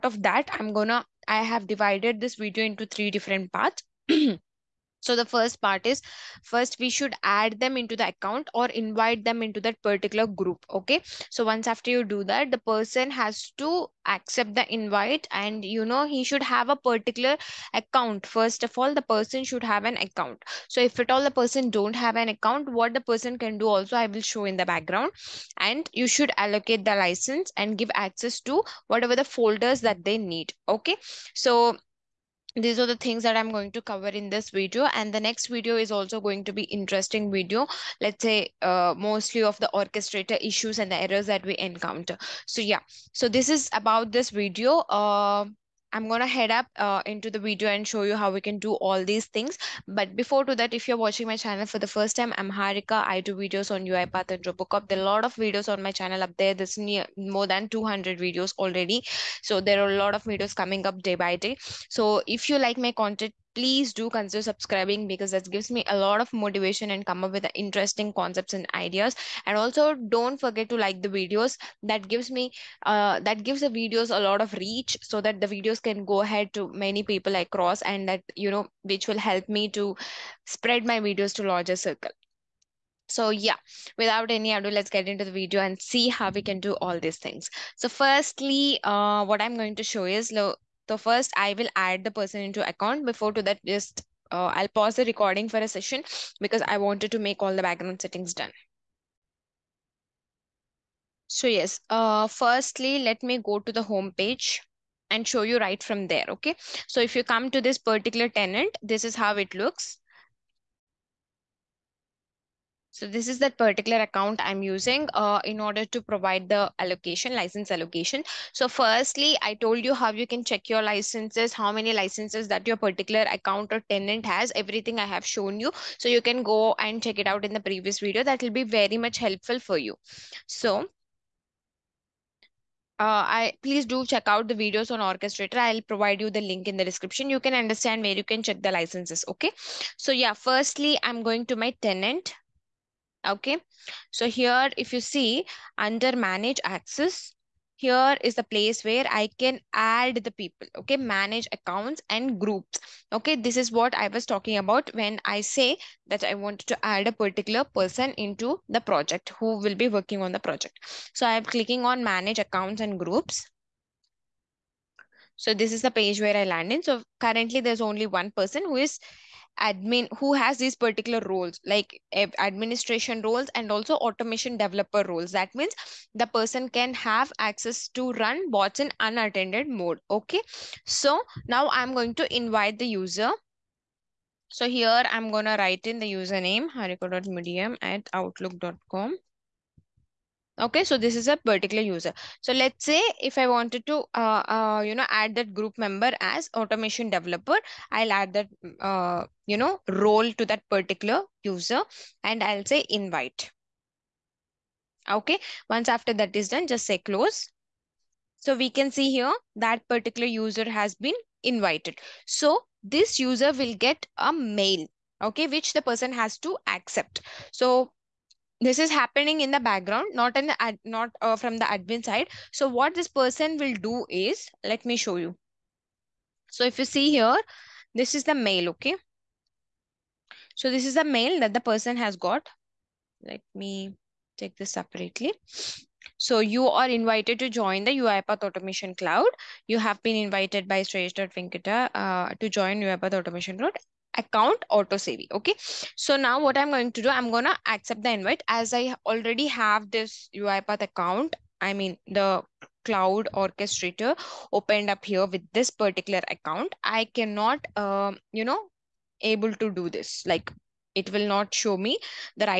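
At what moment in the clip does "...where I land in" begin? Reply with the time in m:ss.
2:46.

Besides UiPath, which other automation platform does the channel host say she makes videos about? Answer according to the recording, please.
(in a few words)
Robocorp.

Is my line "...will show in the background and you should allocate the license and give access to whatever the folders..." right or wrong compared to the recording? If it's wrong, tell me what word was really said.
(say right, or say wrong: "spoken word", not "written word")
right.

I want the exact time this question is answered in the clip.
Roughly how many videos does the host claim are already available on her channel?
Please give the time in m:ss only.
0:57.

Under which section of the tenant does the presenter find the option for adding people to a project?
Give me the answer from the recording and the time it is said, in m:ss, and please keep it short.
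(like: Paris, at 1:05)
Manage access, at 2:26.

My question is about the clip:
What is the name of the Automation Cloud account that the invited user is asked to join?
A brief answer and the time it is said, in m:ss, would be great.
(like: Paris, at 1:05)
Auto savvy, at 4:04.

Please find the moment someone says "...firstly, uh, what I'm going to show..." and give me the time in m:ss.
1:27.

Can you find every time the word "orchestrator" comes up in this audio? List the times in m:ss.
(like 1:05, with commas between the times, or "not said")
0:39, 2:14, 4:13.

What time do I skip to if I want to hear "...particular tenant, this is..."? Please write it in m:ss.
1:47.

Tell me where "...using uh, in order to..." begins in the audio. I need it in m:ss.
1:54.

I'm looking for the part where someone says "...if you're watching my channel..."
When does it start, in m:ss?
0:50.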